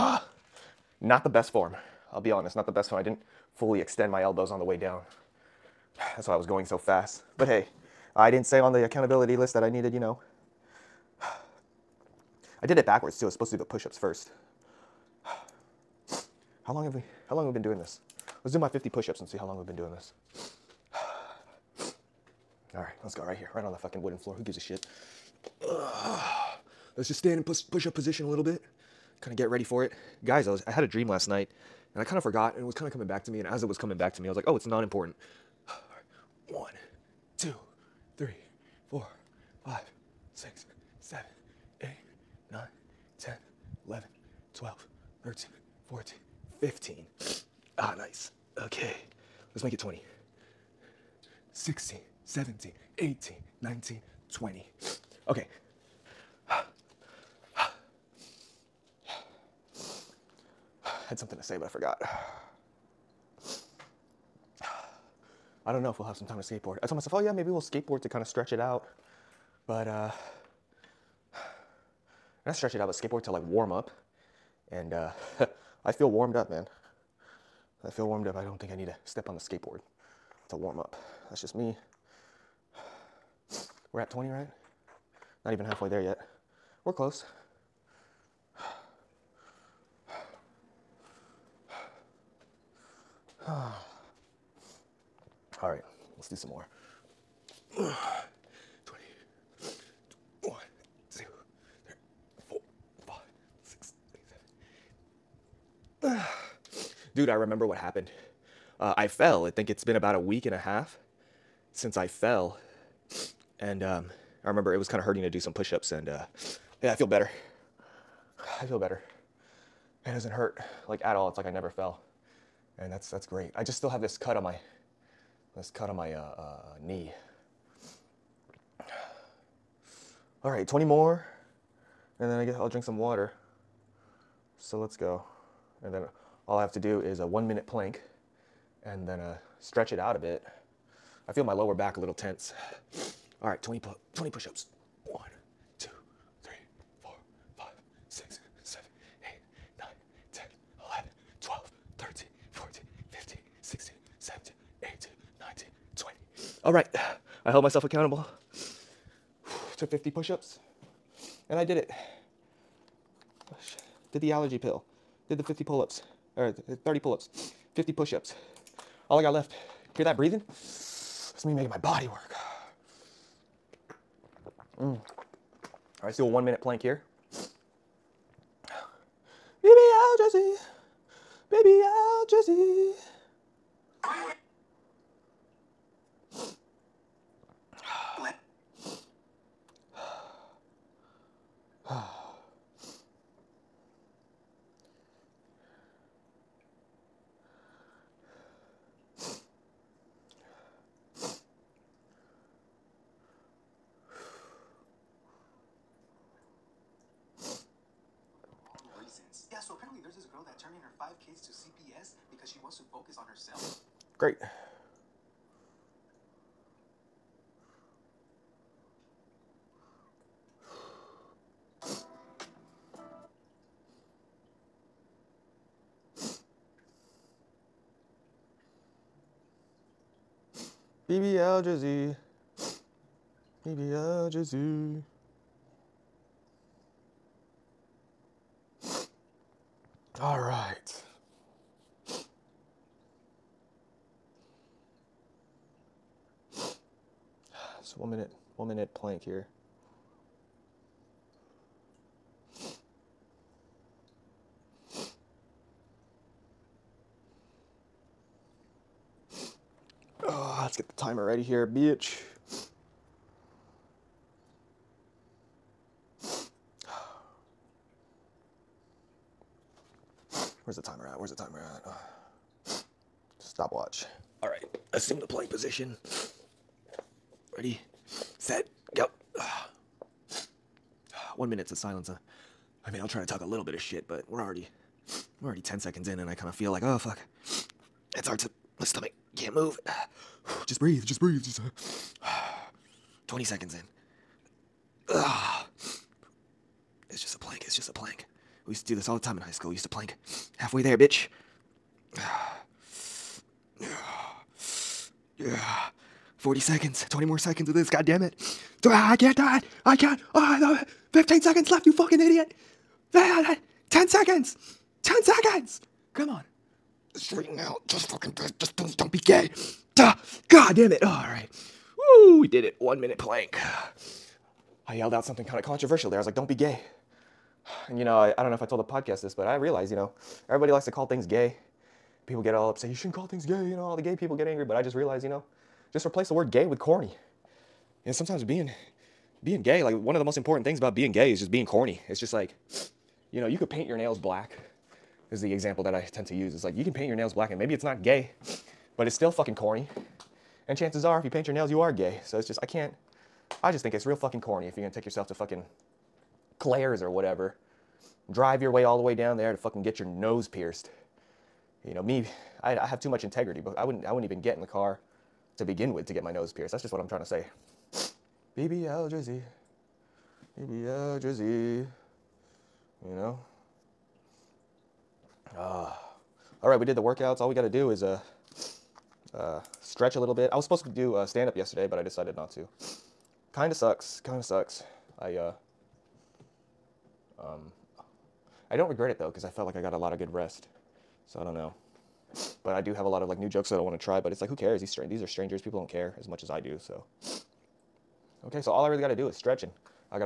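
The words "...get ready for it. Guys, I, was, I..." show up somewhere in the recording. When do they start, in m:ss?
0:29.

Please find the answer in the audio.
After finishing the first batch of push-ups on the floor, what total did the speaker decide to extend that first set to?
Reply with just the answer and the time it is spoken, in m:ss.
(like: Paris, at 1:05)
20, at 0:49.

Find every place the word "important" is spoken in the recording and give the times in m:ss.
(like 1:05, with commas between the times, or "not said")
0:34, 5:40.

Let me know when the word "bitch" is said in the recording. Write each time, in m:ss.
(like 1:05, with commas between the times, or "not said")
4:21, 5:00.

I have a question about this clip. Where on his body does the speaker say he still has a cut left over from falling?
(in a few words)
knee.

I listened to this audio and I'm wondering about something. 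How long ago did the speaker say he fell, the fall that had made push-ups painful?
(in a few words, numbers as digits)
a week and a half.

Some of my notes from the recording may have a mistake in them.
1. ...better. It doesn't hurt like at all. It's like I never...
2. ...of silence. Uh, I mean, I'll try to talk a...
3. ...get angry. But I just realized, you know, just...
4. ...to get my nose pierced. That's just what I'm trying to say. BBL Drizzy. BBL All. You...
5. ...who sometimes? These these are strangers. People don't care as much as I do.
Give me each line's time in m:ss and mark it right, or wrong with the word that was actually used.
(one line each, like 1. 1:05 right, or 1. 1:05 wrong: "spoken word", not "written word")
1. 1:58 right
2. 4:41 right
3. 5:34 right
4. 6:06 wrong: "Drizzy", not "All"
5. 6:34 wrong: "cares", not "sometimes".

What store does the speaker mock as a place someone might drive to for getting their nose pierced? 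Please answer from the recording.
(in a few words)
Claire's.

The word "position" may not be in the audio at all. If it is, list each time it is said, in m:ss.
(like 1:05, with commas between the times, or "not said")
0:27, 4:35.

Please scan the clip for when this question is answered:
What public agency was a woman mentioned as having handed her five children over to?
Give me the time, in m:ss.
3:31.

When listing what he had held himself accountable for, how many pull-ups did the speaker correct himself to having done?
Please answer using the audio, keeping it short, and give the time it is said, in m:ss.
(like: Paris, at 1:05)
30, at 2:46.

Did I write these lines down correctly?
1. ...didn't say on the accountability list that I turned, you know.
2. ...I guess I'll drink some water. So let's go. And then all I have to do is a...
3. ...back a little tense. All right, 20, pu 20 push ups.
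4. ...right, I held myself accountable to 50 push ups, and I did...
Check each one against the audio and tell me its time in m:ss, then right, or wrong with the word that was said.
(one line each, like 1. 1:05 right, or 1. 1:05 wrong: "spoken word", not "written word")
1. 0:08 wrong: "needed", not "turned"
2. 2:12 right
3. 2:21 right
4. 2:36 right.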